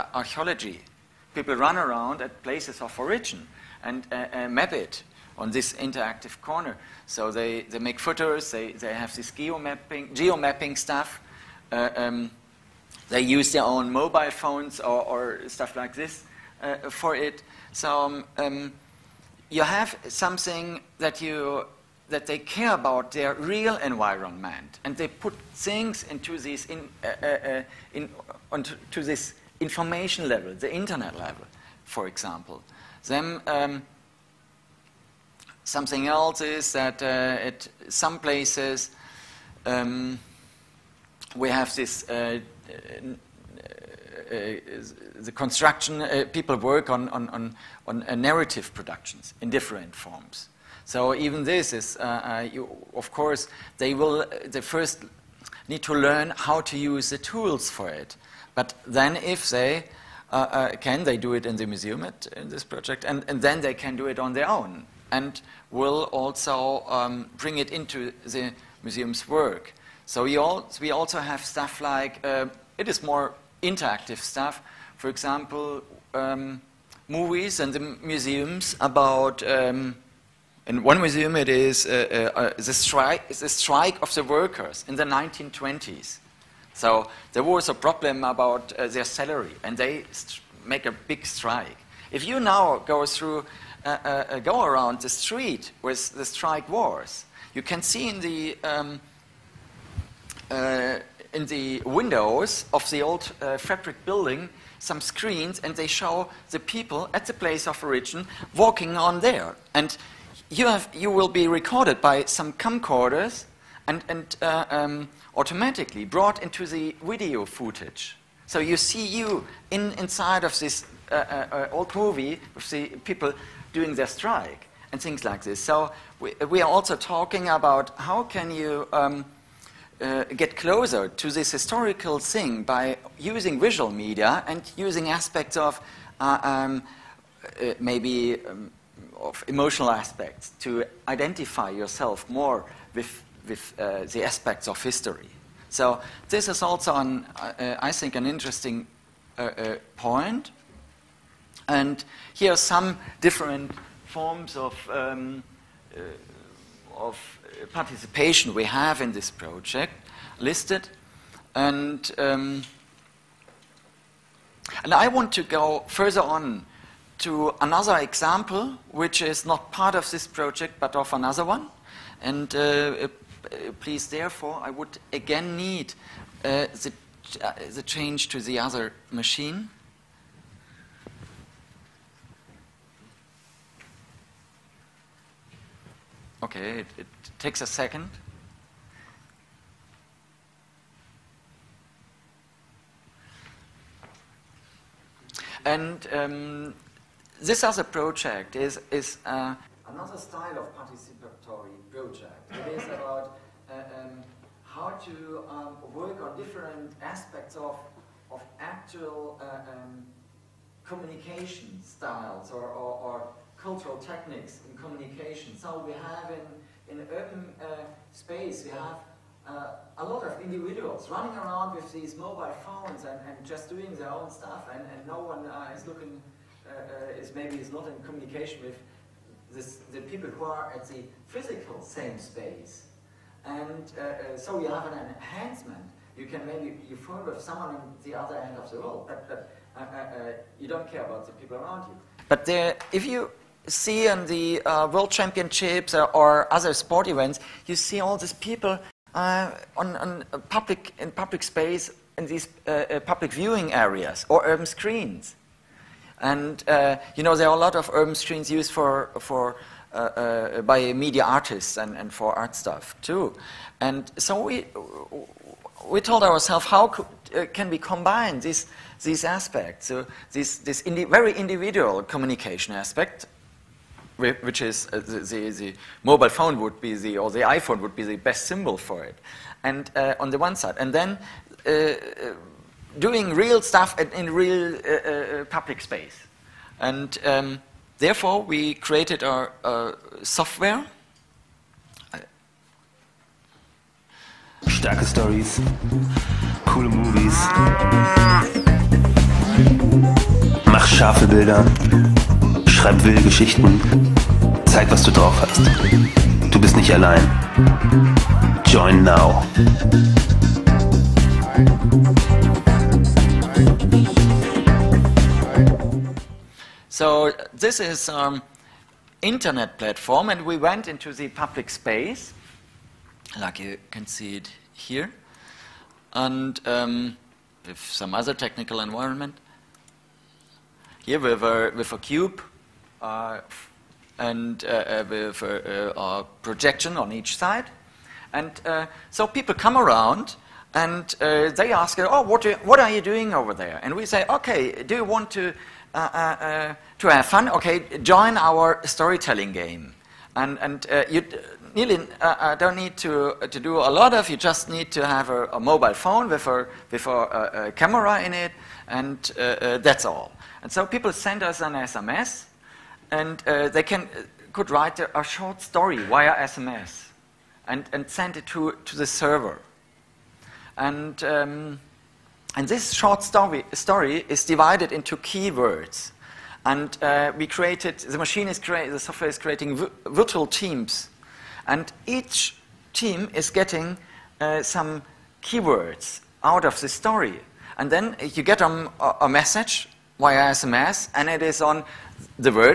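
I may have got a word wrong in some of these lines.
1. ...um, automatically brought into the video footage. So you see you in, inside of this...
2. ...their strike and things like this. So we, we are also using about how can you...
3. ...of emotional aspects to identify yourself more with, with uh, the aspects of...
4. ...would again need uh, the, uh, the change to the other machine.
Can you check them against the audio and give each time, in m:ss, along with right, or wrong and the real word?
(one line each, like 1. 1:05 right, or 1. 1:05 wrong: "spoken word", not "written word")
1. 1:54 right
2. 2:03 wrong: "talking", not "using"
3. 2:19 right
4. 2:54 right.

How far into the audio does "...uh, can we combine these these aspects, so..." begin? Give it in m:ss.
4:27.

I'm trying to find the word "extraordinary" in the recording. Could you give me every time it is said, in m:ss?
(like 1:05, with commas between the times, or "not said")
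not said.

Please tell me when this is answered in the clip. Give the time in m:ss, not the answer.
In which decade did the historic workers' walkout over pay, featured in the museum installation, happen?
1:25.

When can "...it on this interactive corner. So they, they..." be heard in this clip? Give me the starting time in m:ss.
0:04.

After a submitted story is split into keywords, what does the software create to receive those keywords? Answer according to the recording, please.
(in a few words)
virtual teams.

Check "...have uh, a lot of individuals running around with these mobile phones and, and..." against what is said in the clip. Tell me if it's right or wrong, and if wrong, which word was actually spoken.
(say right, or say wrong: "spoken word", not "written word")
right.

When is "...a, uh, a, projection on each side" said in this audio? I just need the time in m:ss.
5:35.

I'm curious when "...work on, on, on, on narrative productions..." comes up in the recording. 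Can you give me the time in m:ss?
0:46.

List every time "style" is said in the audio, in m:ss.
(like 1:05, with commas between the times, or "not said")
3:20, 3:31.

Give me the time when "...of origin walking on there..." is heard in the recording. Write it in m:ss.
1:47.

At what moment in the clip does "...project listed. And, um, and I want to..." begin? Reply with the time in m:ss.
2:39.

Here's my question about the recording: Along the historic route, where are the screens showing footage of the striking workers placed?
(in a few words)
windows of the old fabric building.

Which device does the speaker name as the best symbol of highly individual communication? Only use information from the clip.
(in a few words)
iPhone.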